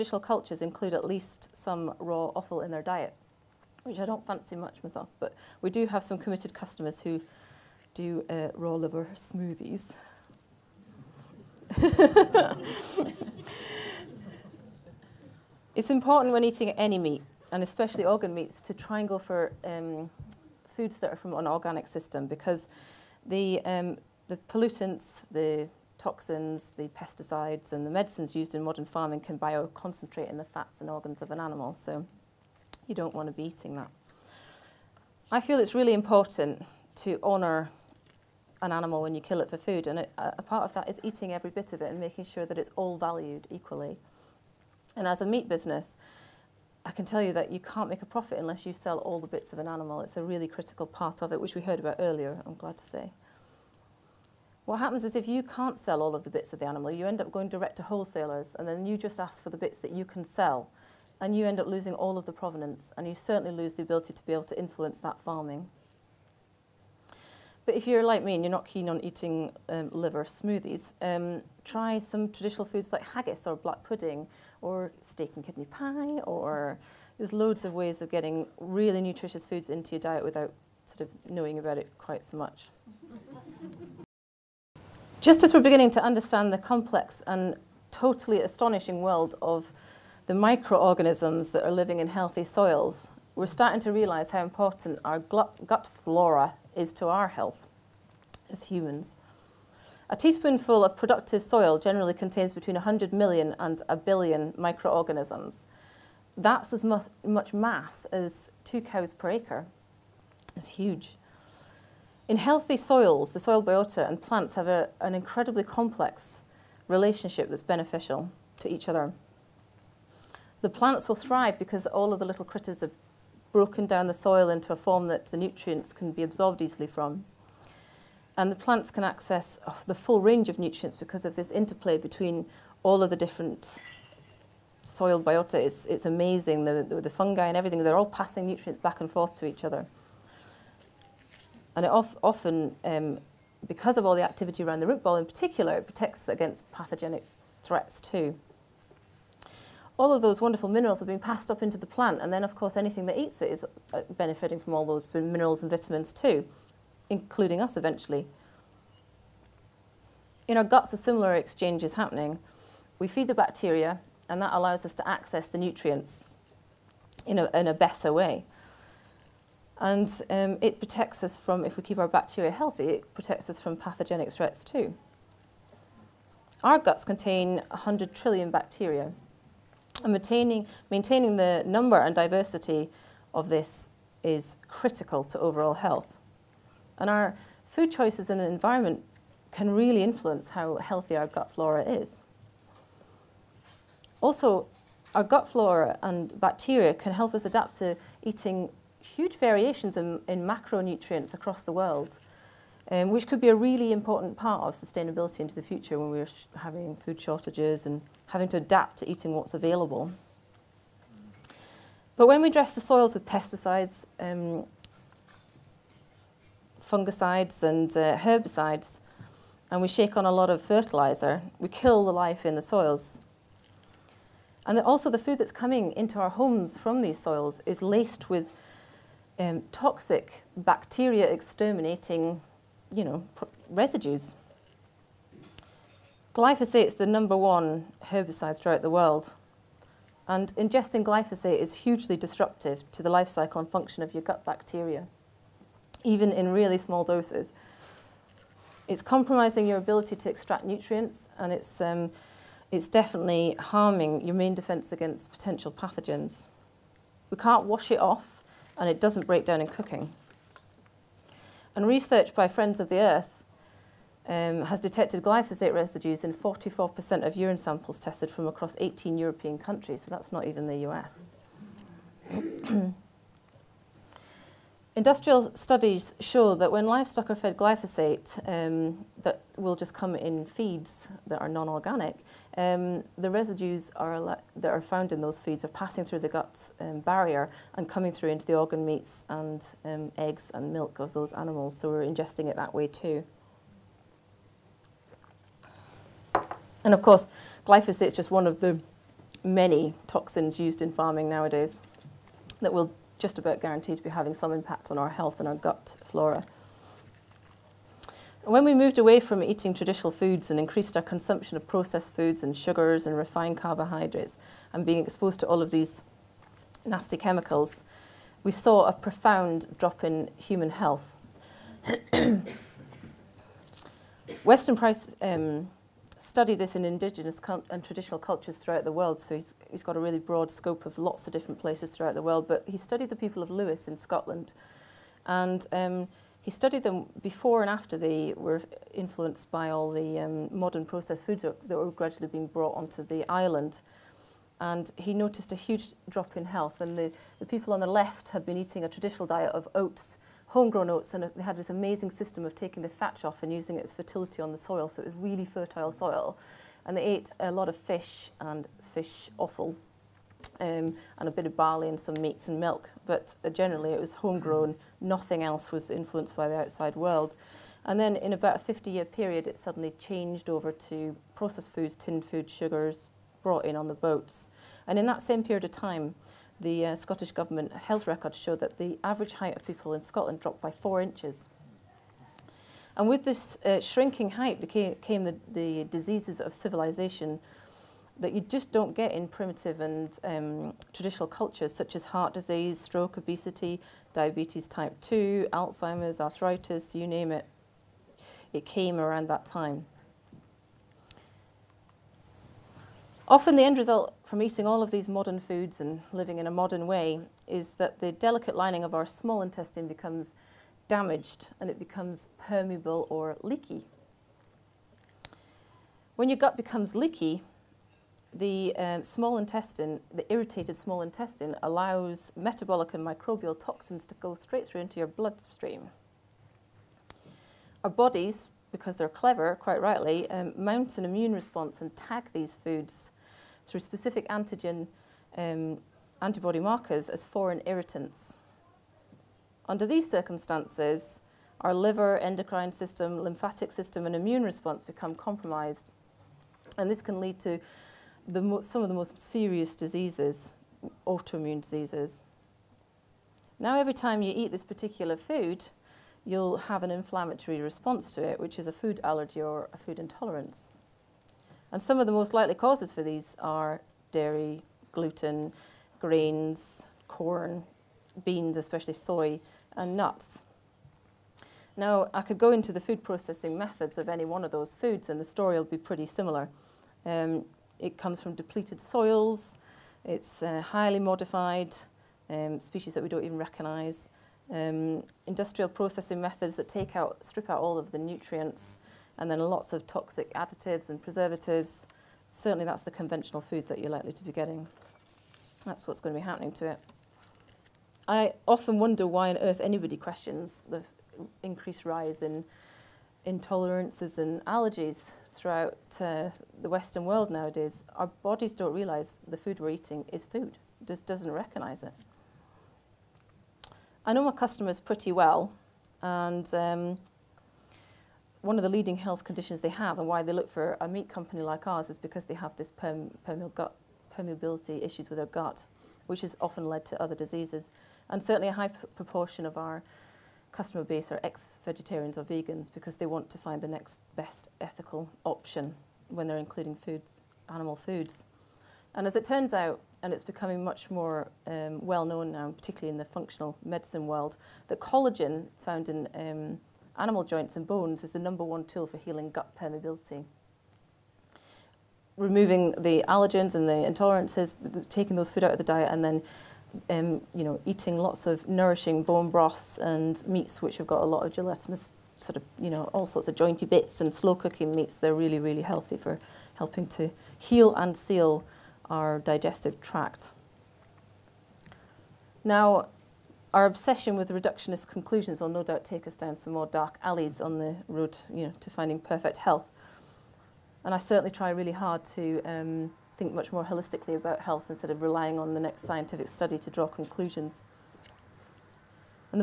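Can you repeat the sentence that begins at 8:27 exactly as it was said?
Our bodies don't realise the food we're eating is food, it just doesn't recognise it.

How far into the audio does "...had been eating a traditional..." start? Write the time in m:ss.
5:48.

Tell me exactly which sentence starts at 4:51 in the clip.
So we're ingesting it that way too.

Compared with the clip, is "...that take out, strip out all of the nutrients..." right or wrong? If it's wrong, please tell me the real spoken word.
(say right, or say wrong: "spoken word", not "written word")
right.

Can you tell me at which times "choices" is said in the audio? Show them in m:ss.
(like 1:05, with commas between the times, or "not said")
3:07.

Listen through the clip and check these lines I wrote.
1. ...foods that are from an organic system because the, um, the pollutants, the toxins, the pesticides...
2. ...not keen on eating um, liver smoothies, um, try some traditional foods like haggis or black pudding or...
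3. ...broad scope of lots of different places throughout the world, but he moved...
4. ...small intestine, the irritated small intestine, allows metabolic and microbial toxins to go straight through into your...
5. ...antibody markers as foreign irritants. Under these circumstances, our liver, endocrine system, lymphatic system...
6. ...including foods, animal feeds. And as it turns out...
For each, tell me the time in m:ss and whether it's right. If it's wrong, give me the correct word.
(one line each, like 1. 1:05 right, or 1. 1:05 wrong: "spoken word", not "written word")
1. 0:20 right
2. 1:08 right
3. 5:30 wrong: "studied", not "moved"
4. 6:59 right
5. 7:16 right
6. 8:56 wrong: "foods", not "feeds".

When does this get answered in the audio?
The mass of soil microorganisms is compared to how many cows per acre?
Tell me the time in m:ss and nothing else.
1:48.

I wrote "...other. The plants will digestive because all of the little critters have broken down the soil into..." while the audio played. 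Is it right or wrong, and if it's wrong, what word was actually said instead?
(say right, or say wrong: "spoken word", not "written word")
wrong: "thrive", not "digestive".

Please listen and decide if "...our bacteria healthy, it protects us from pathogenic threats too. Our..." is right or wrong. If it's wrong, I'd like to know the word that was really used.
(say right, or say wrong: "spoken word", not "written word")
right.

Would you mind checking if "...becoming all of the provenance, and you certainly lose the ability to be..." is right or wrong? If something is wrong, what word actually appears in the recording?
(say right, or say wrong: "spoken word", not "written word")
wrong: "losing", not "becoming".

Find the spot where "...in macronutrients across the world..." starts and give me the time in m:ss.
3:20.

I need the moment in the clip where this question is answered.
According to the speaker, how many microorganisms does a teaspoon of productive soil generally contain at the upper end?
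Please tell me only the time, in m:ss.
1:43.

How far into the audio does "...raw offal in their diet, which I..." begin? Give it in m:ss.
0:01.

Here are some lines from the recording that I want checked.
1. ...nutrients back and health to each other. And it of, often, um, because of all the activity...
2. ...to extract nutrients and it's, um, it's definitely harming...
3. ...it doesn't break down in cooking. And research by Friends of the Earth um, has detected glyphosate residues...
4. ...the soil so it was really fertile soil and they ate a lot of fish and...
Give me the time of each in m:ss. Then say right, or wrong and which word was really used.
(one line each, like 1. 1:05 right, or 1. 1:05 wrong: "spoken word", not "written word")
1. 2:18 wrong: "forth", not "health"
2. 4:10 right
3. 4:18 right
4. 5:54 right.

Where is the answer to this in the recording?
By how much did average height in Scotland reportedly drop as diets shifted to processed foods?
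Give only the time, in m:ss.
6:20.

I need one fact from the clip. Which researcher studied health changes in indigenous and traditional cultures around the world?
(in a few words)
Weston Price.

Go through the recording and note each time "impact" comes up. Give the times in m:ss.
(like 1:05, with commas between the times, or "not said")
5:04.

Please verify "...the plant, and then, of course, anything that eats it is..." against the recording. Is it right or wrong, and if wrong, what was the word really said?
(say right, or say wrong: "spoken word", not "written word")
right.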